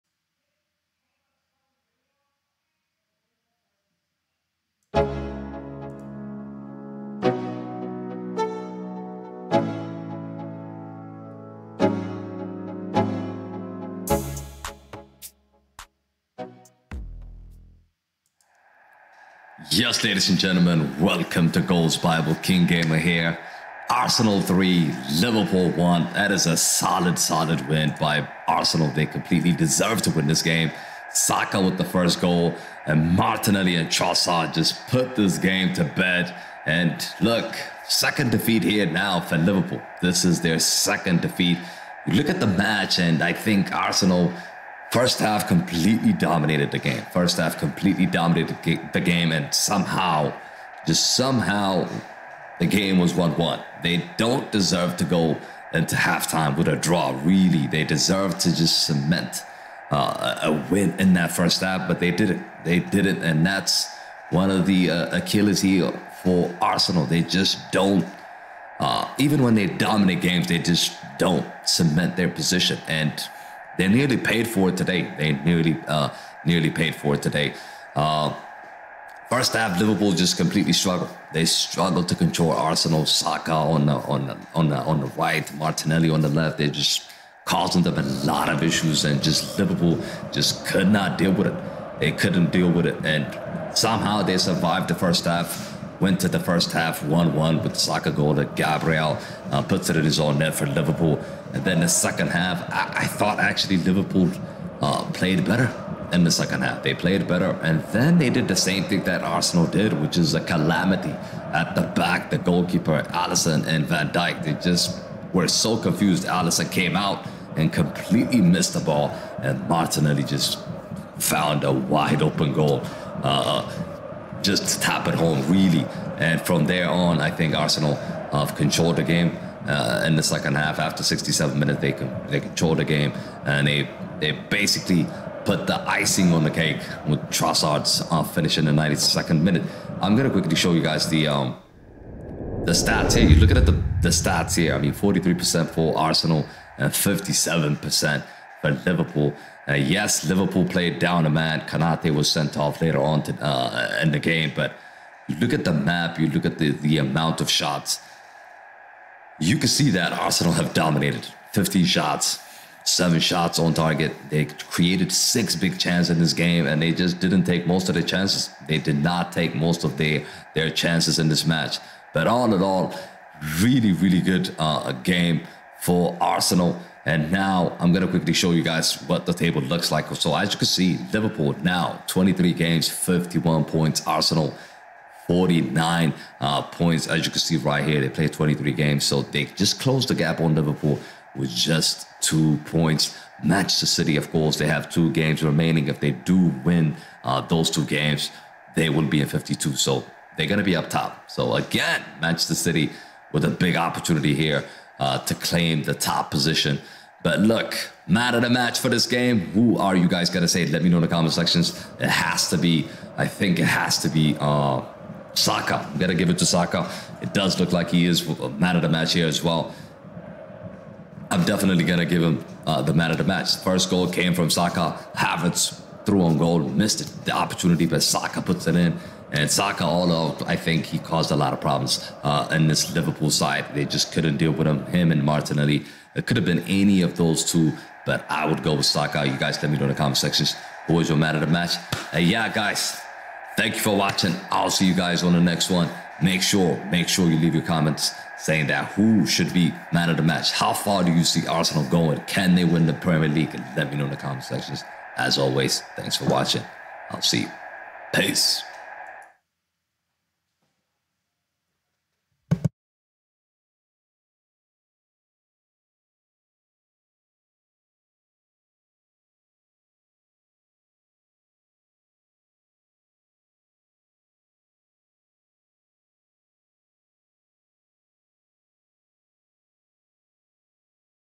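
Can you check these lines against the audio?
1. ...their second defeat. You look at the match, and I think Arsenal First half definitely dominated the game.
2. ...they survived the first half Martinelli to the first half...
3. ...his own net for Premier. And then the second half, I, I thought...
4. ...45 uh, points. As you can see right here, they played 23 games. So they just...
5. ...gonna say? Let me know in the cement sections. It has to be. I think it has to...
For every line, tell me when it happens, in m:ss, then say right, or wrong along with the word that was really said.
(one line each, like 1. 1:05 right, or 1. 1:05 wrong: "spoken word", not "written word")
1. 0:40 wrong: "completely", not "definitely"
2. 1:34 wrong: "Went", not "Martinelli"
3. 1:40 wrong: "Liverpool", not "Premier"
4. 3:05 wrong: "49", not "45"
5. 3:30 wrong: "comment", not "cement".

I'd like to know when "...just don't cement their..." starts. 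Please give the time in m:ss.
1:10.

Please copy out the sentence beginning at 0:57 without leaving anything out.
They deserve to just cement uh, a win in that first half, but they didn't.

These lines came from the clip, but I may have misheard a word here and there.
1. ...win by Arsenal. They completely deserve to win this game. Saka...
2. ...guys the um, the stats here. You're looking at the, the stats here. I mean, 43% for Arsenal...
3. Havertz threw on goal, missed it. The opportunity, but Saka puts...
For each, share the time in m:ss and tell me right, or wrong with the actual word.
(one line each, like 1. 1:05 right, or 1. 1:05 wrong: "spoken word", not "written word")
1. 0:27 right
2. 2:20 right
3. 3:45 right.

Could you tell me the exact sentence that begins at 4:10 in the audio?
How far do you see Arsenal going?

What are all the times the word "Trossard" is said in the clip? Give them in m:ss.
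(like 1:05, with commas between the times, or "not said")
0:33, 2:17.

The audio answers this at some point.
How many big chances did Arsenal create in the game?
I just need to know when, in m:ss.
2:45.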